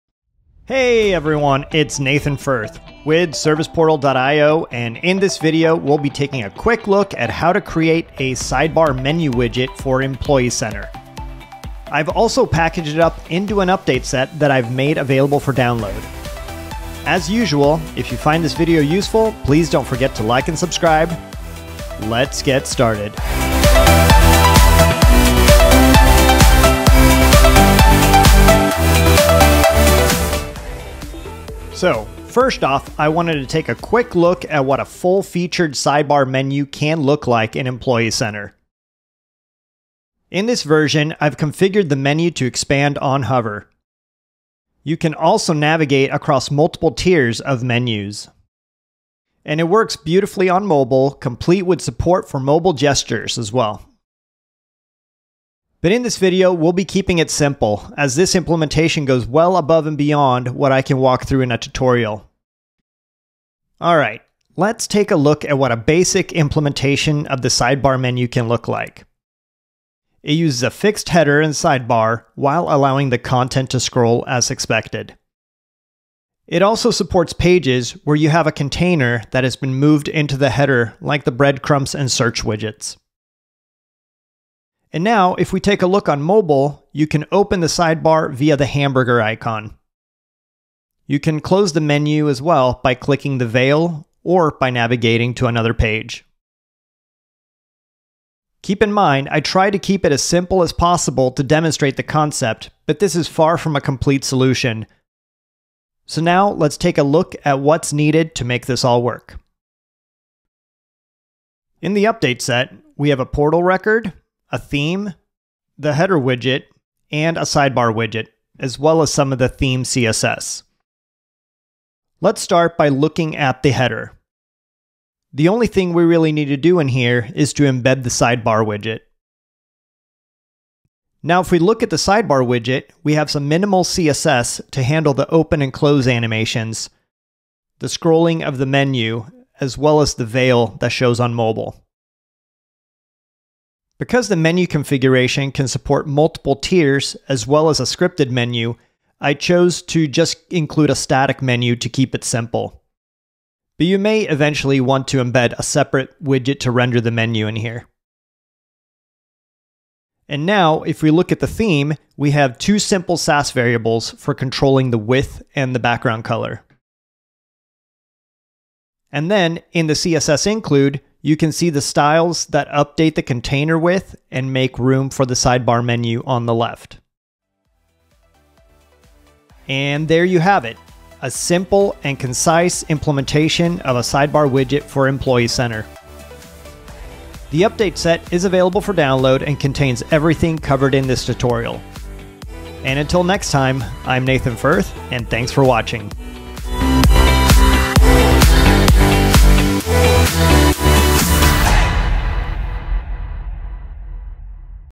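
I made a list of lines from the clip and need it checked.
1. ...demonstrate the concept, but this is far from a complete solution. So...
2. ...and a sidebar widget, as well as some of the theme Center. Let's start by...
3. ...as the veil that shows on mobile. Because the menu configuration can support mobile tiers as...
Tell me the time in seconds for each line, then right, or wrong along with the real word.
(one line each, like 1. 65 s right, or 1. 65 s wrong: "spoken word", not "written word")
1. 101 s right
2. 117 s wrong: "CSS", not "Center"
3. 140 s wrong: "multiple", not "mobile".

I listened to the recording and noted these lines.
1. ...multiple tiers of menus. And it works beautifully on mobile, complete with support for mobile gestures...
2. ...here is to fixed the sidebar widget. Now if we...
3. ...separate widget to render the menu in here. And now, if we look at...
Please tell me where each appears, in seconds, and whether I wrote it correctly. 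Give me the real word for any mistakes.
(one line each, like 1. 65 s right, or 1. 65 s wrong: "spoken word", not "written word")
1. 46 s right
2. 126 s wrong: "embed", not "fixed"
3. 155 s right.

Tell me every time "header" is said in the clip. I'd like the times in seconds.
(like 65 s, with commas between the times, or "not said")
71 s, 80 s, 115 s, 123 s.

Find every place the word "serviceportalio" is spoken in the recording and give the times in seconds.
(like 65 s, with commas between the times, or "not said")
3 s.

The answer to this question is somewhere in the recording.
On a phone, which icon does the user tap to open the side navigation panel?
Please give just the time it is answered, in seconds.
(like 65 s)
88 s.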